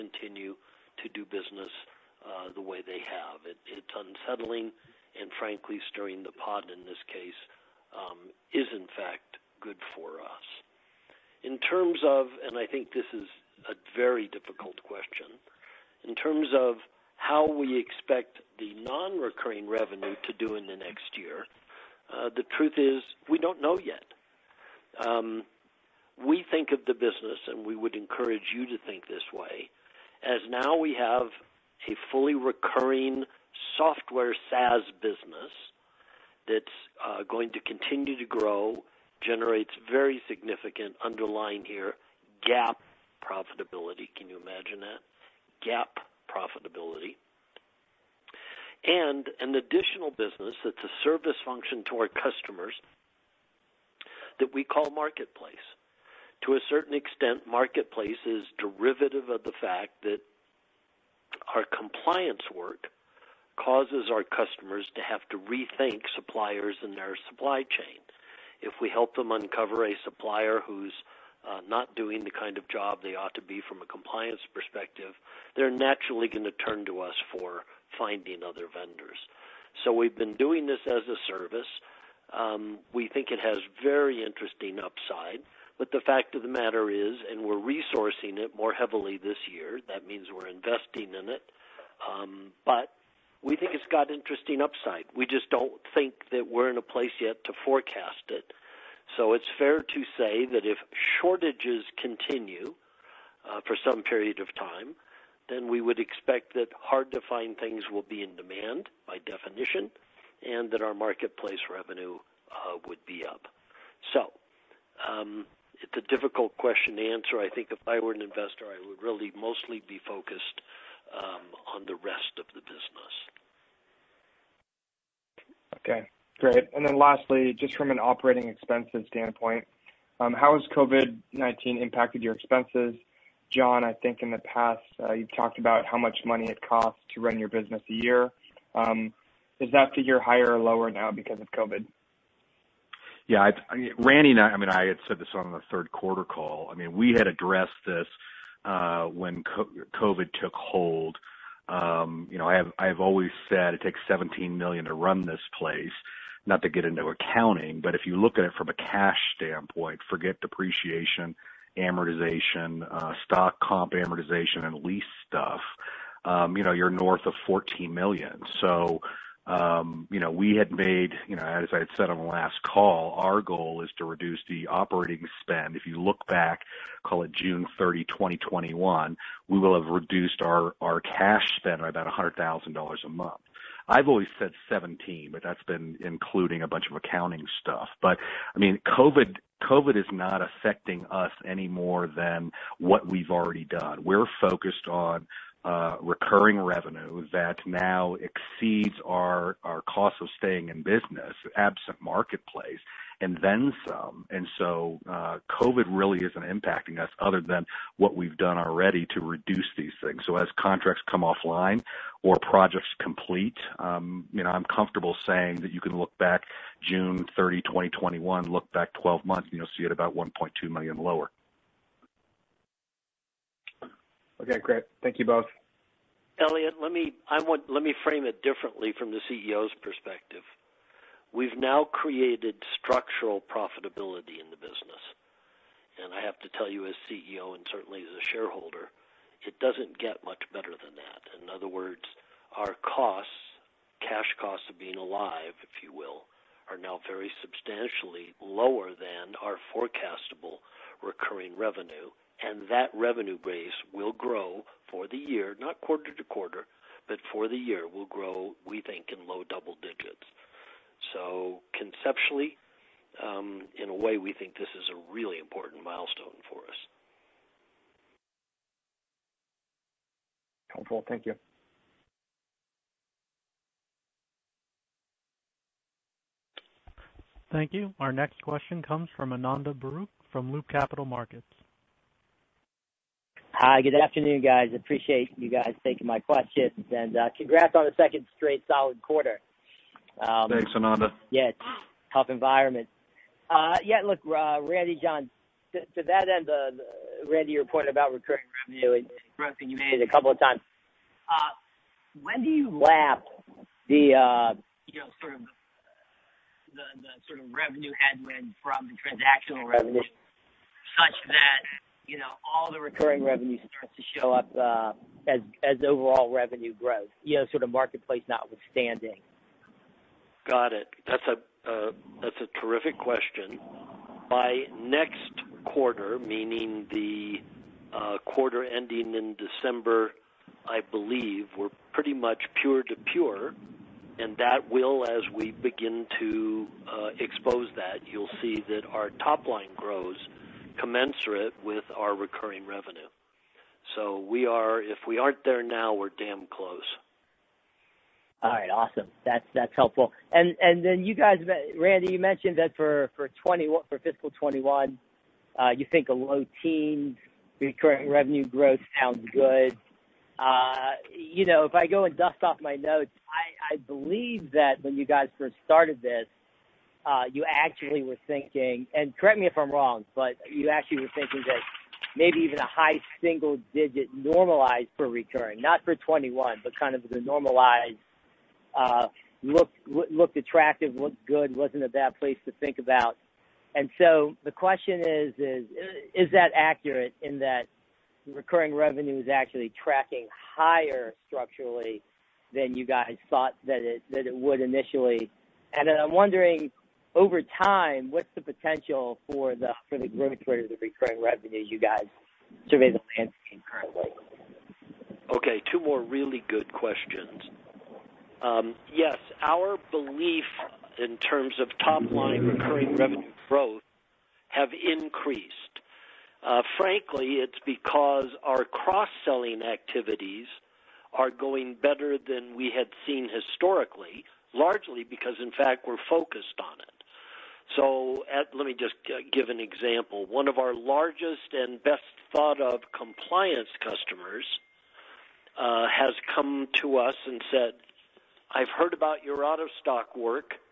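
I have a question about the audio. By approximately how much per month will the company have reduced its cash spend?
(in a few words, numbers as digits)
$100,000.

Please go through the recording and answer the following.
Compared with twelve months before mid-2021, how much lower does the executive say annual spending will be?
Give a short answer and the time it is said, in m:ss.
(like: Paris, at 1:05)
$1.2, at 3:40.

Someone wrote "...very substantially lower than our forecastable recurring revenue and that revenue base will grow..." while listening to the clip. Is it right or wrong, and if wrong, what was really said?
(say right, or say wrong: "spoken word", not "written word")
right.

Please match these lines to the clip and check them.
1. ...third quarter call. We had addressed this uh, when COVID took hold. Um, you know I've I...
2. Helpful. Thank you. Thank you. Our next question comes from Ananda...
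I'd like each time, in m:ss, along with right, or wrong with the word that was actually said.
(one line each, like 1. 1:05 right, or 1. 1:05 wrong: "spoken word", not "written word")
1. 2:25 right
2. 4:30 right.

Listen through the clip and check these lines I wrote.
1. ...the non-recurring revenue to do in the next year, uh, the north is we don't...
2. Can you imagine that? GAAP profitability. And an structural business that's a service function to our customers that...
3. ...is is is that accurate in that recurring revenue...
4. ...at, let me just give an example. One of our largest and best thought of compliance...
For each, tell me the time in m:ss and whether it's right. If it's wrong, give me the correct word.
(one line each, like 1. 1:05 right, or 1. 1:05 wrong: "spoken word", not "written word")
1. 0:18 wrong: "truth", not "north"
2. 0:44 wrong: "additional", not "structural"
3. 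6:25 right
4. 7:08 right.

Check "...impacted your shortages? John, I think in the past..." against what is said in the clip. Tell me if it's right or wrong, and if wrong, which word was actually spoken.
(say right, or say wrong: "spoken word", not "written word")
wrong: "expenses", not "shortages".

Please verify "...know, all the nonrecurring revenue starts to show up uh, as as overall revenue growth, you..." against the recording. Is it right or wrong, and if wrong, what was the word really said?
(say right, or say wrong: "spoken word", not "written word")
wrong: "recurring", not "nonrecurring".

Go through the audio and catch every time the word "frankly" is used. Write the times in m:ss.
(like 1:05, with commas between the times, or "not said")
0:05, 6:56.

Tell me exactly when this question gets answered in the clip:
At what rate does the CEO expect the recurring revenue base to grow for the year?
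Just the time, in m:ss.
4:19.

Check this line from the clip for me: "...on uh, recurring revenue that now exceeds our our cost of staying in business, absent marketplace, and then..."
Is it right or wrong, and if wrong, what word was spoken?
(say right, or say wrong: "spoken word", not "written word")
right.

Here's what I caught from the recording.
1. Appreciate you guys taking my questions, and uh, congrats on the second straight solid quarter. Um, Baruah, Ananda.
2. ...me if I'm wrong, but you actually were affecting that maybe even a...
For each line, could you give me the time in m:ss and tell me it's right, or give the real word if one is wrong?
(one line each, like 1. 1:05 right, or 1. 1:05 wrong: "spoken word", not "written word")
1. 4:44 wrong: "Thanks", not "Baruah"
2. 6:09 wrong: "thinking", not "affecting".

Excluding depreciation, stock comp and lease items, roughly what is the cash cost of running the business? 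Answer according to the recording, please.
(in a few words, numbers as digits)
north of $14.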